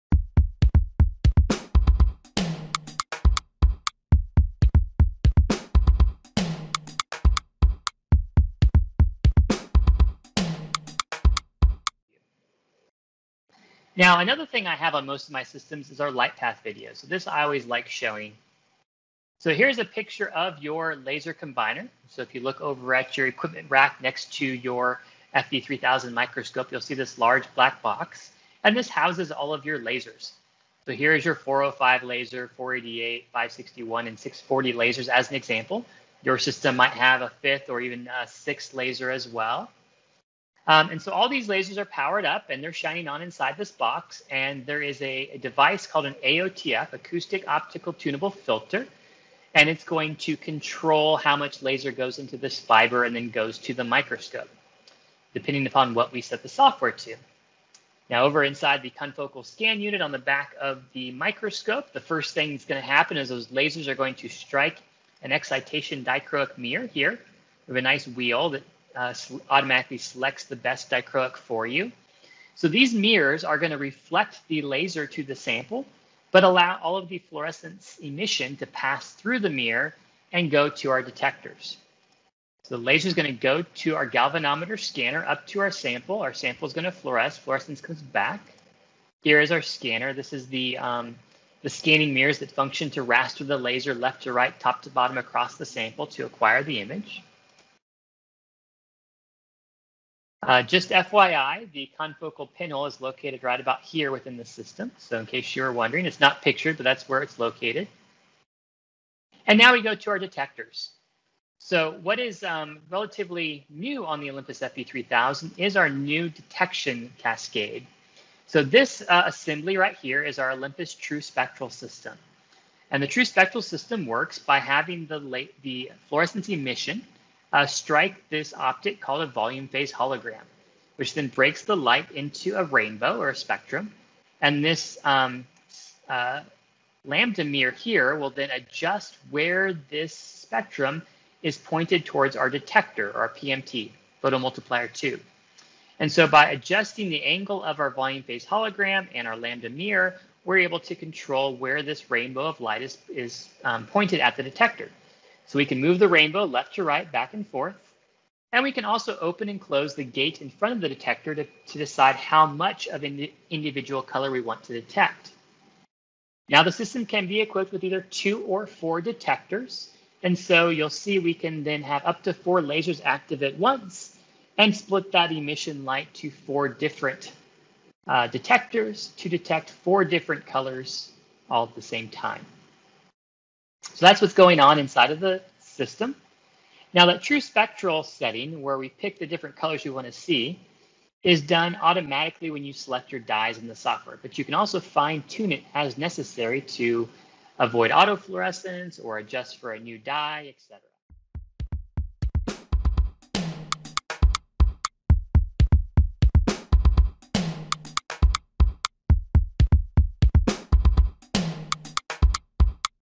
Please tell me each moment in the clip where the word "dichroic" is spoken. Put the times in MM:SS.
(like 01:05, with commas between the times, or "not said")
01:06, 01:10.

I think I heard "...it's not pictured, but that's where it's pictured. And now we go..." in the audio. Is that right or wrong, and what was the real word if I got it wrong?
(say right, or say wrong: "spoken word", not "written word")
wrong: "located", not "pictured".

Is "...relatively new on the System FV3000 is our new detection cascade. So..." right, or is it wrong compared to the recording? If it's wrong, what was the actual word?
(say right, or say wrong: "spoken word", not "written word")
wrong: "Olympus", not "System".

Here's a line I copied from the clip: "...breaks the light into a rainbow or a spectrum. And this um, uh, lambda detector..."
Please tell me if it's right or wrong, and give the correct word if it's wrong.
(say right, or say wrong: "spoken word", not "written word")
wrong: "mirror", not "detector".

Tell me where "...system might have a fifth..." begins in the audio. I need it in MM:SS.
00:36.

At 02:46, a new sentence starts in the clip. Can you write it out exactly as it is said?
Now the system can be equipped with either two or four detectors.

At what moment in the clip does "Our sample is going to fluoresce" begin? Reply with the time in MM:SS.
01:26.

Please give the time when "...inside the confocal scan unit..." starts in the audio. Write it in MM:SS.
00:58.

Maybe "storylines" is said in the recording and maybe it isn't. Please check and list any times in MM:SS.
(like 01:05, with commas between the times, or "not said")
not said.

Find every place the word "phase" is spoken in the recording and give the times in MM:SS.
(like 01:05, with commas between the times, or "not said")
02:09, 02:28.